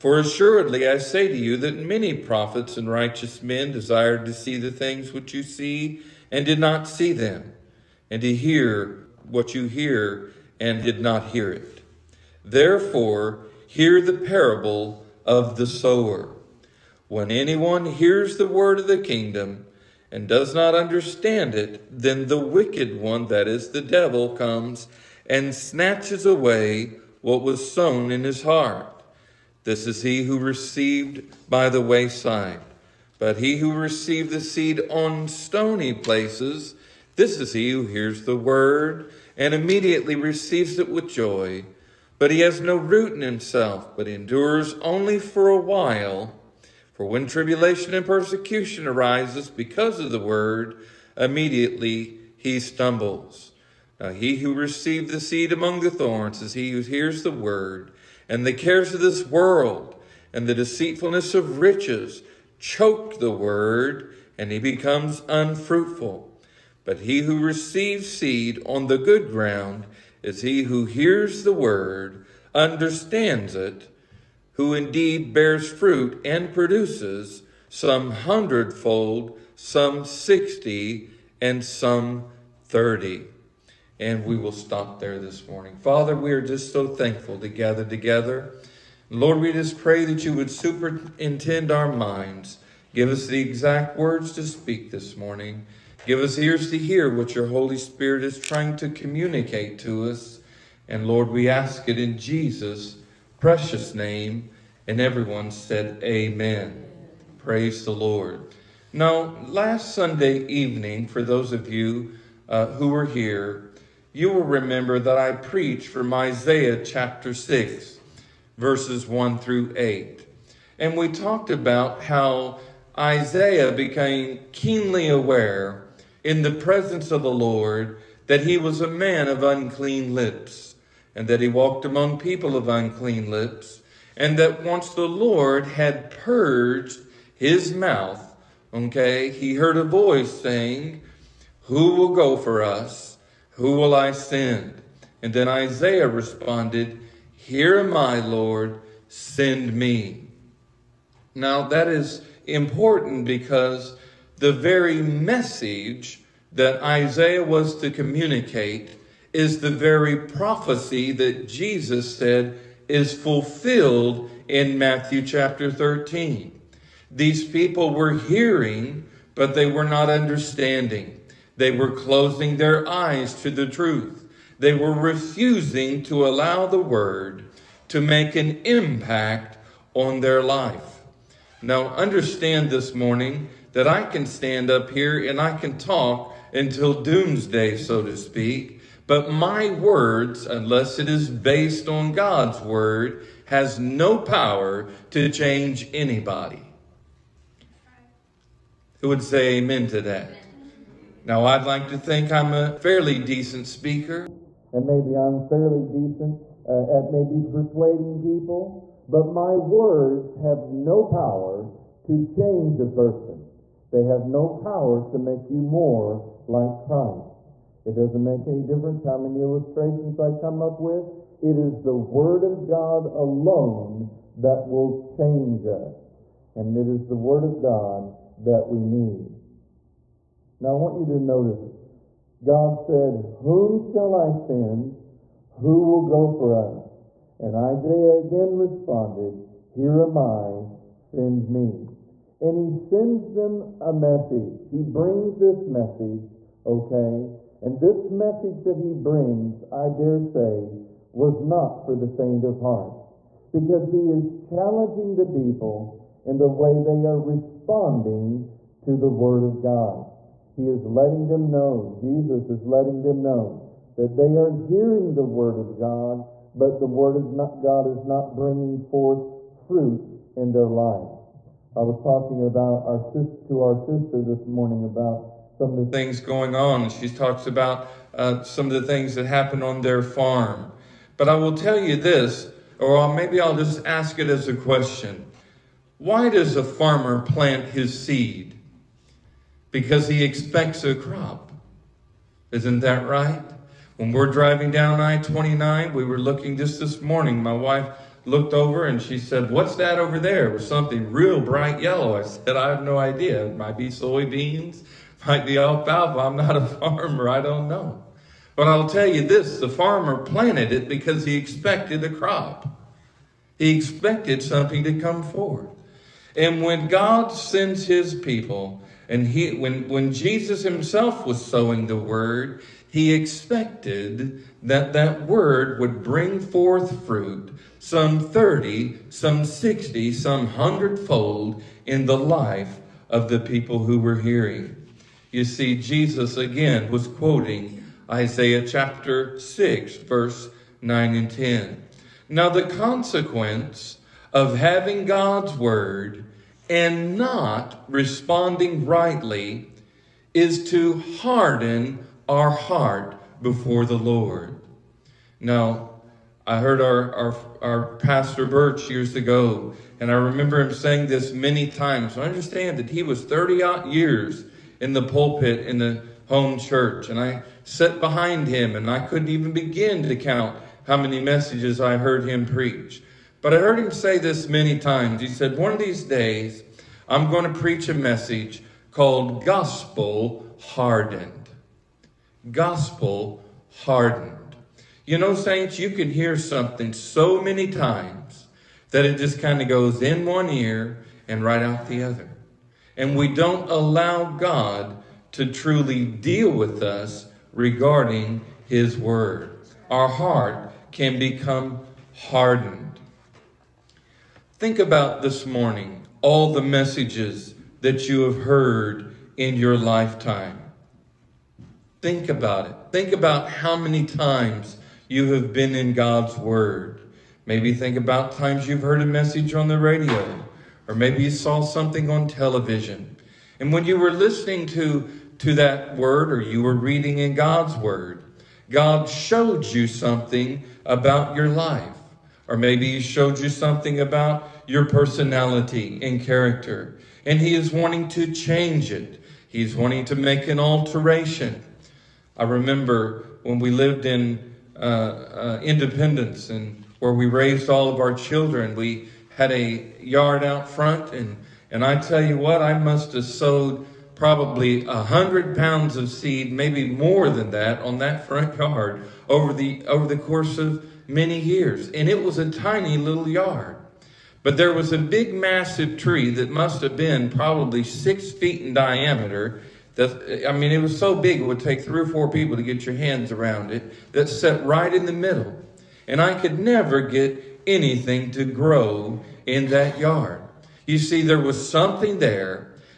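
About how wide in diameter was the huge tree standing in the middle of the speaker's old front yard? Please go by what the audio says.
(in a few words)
6 feet.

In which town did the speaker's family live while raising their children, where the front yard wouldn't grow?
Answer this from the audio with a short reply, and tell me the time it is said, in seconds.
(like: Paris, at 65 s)
Independence, at 445 s.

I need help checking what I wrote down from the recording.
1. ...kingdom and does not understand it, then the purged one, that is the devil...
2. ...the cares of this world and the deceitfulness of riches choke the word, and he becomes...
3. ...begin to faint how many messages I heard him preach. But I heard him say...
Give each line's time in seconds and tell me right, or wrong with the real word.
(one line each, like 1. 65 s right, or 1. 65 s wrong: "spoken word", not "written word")
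1. 19 s wrong: "wicked", not "purged"
2. 58 s right
3. 369 s wrong: "count", not "faint".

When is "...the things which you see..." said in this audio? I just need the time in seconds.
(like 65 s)
4 s.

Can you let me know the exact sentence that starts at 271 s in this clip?
I was talking about our to our sister this morning about some of the things going on.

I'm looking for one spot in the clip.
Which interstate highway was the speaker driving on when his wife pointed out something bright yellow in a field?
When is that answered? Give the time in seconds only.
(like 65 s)
294 s.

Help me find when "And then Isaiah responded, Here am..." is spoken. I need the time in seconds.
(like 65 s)
145 s.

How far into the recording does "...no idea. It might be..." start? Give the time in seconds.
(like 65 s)
302 s.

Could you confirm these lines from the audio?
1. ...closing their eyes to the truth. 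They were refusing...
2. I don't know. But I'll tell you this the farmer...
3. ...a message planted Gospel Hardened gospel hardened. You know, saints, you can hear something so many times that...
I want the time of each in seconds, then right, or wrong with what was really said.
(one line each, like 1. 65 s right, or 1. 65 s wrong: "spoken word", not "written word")
1. 171 s right
2. 307 s right
3. 377 s wrong: "called", not "planted".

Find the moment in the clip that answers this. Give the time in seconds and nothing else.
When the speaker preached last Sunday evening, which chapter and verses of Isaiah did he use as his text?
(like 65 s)
116 s.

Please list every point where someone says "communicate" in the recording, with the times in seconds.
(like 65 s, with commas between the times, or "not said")
98 s, 157 s.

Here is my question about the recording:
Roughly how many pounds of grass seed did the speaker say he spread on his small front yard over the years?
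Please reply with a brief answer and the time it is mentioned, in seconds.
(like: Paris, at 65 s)
100, at 454 s.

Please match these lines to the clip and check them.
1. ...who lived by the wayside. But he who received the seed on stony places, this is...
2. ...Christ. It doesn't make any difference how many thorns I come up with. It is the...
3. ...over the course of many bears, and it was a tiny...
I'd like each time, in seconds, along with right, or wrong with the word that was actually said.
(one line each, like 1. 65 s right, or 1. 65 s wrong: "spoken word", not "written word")
1. 30 s wrong: "received", not "lived"
2. 216 s wrong: "illustrations", not "thorns"
3. 459 s wrong: "years", not "bears".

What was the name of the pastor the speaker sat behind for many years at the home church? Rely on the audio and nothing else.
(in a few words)
Birch.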